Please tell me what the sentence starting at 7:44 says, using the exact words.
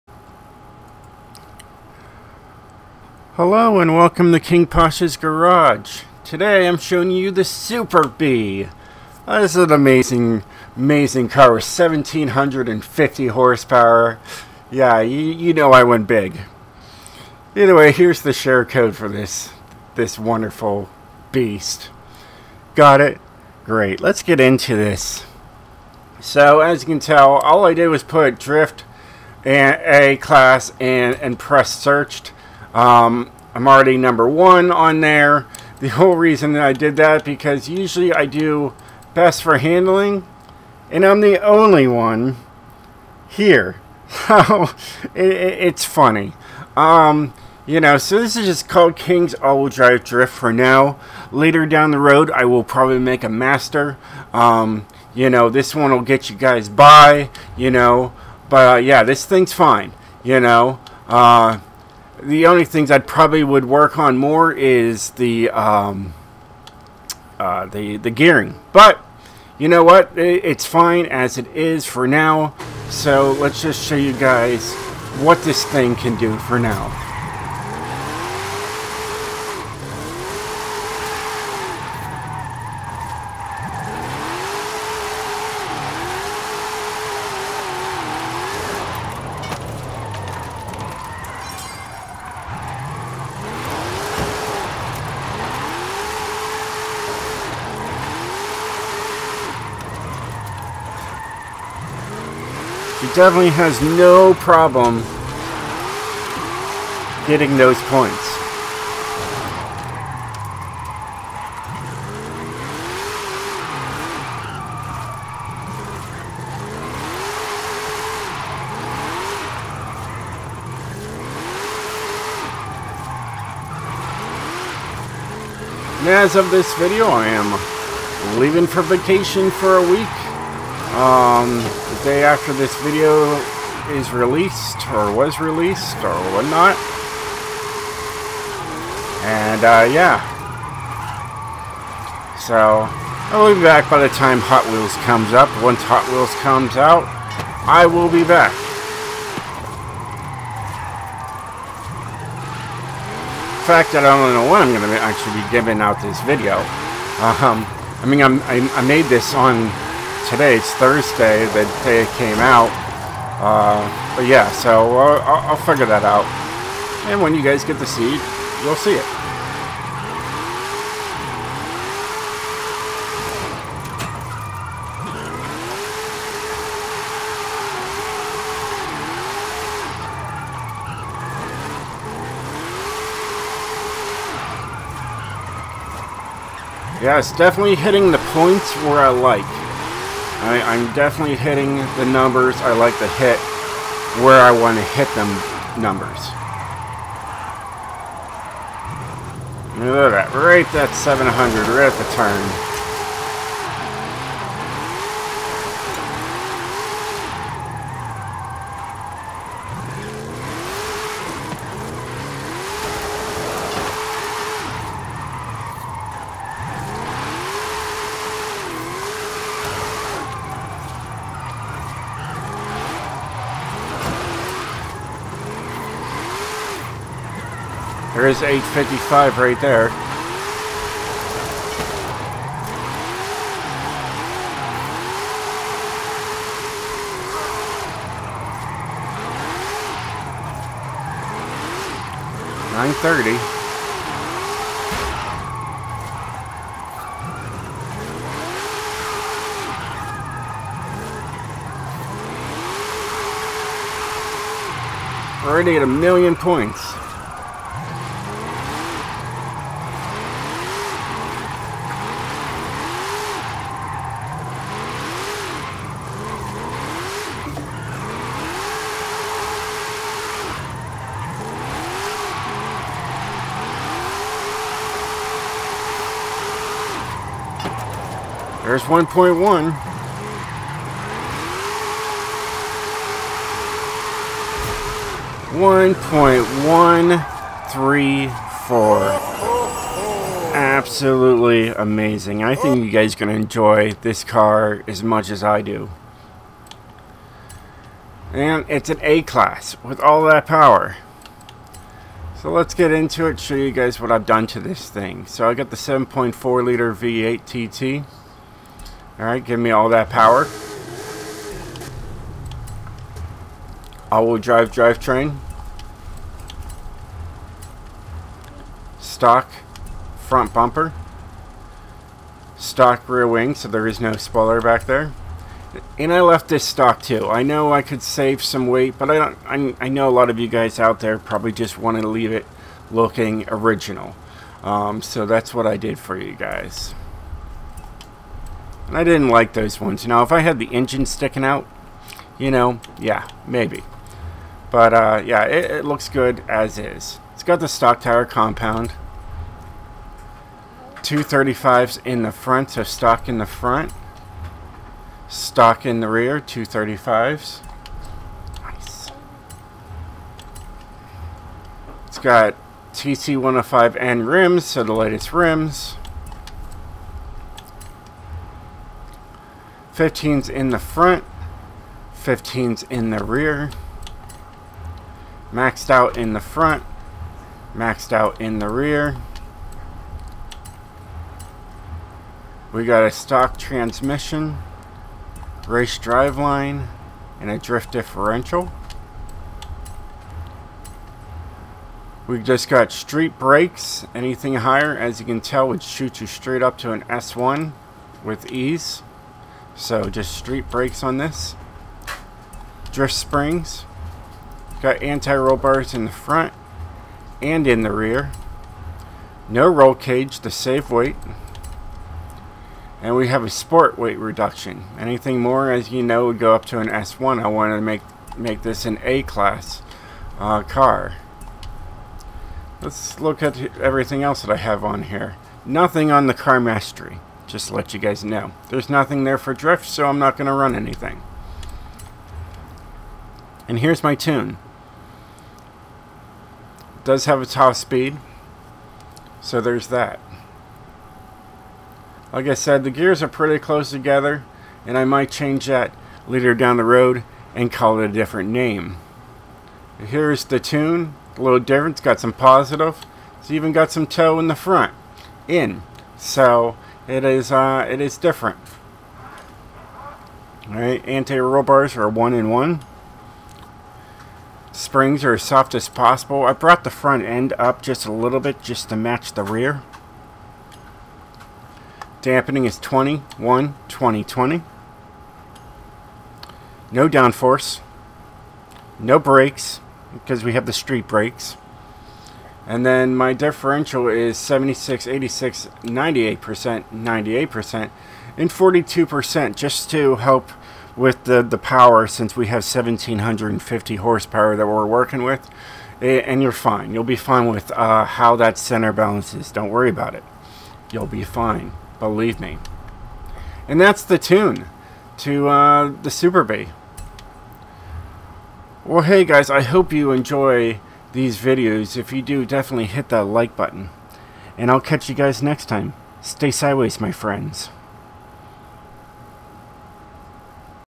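Springs are as soft as possible.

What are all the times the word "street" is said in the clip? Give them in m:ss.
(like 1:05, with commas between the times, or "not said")
6:32, 6:40, 8:00.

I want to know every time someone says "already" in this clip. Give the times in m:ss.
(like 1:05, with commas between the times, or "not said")
0:33, 4:15.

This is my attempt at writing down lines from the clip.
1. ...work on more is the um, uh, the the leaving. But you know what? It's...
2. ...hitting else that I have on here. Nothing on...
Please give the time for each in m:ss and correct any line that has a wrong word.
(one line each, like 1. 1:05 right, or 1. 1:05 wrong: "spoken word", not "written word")
1. 1:03 wrong: "gearing", not "leaving"
2. 7:03 wrong: "everything", not "hitting".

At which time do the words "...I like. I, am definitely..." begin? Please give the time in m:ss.
3:08.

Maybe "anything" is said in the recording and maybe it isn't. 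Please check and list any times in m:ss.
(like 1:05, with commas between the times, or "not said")
6:34, 6:54, 7:10.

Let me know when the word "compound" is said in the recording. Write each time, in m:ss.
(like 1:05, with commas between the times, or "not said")
5:48.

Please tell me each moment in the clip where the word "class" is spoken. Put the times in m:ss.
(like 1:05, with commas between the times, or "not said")
0:30, 4:59, 6:59.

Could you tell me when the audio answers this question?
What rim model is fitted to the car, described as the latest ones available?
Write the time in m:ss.
6:02.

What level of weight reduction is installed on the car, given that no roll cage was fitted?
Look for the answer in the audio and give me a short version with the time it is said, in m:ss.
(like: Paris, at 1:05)
sport, at 6:53.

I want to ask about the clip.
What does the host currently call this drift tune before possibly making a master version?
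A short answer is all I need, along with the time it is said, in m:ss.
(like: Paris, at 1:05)
King's all Drive Drift, at 0:48.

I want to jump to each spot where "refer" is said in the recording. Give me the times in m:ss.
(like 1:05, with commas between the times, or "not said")
not said.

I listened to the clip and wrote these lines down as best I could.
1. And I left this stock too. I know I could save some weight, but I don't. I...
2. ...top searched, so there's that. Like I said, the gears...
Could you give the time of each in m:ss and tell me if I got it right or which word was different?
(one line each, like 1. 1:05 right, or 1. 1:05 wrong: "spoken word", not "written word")
1. 5:25 right
2. 7:17 wrong: "speed", not "searched".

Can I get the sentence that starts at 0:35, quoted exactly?
The whole reason that I did that because usually I do best for handling and I'm the only one here.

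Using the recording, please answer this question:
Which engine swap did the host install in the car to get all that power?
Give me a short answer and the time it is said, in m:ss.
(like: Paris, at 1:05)
7.4 liter V8 TT, at 5:05.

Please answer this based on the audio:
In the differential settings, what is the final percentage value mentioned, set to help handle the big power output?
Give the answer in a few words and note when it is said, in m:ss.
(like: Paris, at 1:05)
42%, at 8:08.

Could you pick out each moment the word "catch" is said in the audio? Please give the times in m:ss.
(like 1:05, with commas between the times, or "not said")
8:34.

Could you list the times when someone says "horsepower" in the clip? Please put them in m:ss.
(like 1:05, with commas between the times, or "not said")
0:13, 8:13.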